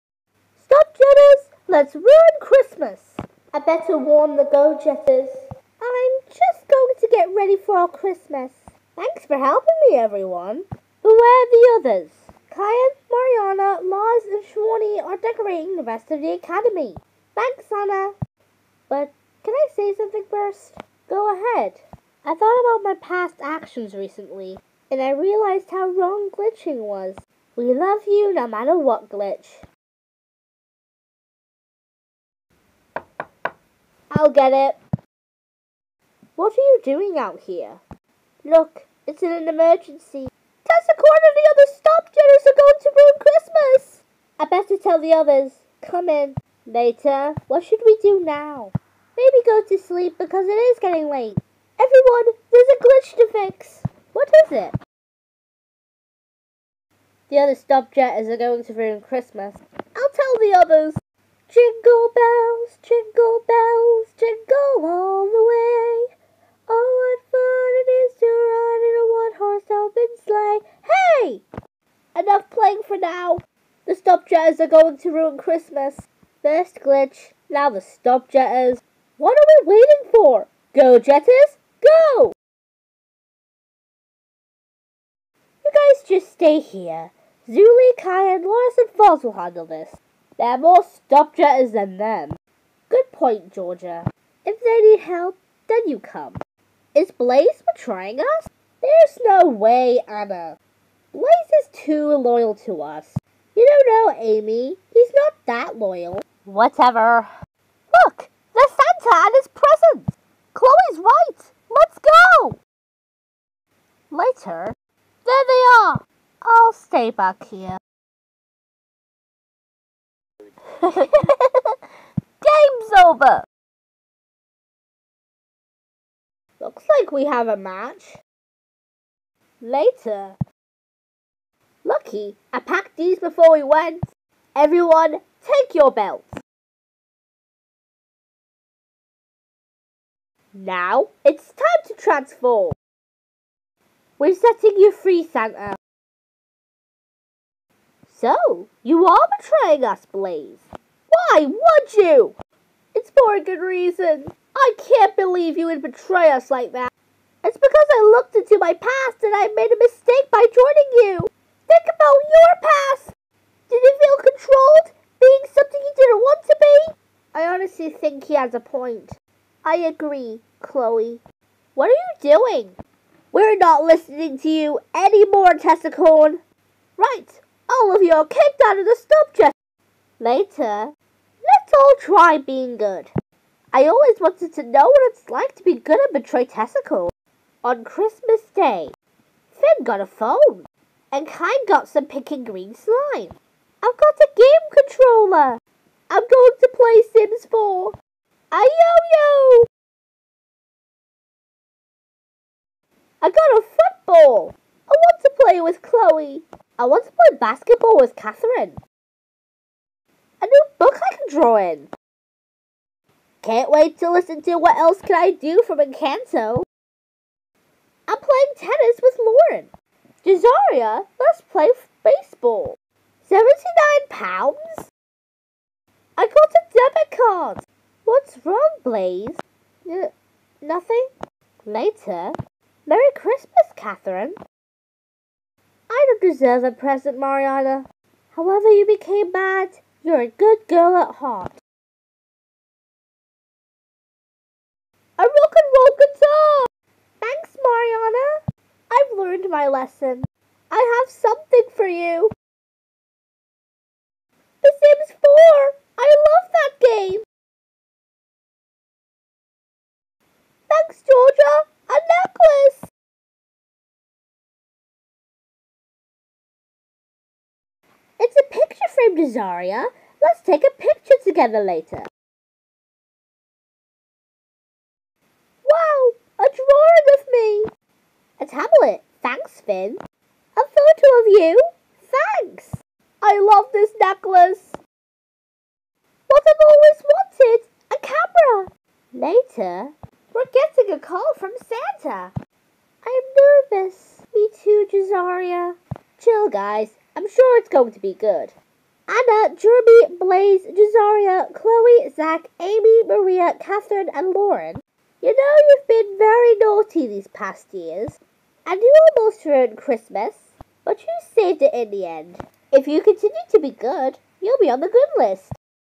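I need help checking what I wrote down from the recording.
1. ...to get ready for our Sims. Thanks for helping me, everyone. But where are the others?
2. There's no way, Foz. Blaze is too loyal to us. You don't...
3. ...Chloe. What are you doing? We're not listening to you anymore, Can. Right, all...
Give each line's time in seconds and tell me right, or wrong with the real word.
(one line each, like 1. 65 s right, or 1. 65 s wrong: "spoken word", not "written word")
1. 6 s wrong: "Christmas", not "Sims"
2. 98 s wrong: "Anna", not "Foz"
3. 170 s wrong: "Tessicone", not "Can".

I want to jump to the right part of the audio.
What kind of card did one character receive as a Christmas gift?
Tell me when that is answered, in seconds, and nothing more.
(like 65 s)
226 s.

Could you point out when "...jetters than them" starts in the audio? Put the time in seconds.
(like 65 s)
91 s.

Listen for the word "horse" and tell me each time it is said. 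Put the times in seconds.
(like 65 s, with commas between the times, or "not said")
69 s.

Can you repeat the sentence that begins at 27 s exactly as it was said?
We love you no matter what glitch.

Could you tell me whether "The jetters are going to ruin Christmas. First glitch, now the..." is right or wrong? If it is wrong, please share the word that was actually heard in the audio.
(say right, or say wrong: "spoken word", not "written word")
right.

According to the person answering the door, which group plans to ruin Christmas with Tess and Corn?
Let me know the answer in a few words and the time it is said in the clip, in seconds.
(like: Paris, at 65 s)
Stop Jetters, at 41 s.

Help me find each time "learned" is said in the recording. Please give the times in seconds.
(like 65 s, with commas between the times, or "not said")
249 s.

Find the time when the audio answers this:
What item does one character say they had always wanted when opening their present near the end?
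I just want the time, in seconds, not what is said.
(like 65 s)
287 s.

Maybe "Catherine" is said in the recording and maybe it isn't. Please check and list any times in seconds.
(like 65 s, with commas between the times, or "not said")
208 s, 233 s, 303 s.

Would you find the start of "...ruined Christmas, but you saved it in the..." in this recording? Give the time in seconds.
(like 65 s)
309 s.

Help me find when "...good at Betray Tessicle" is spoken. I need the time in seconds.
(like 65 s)
185 s.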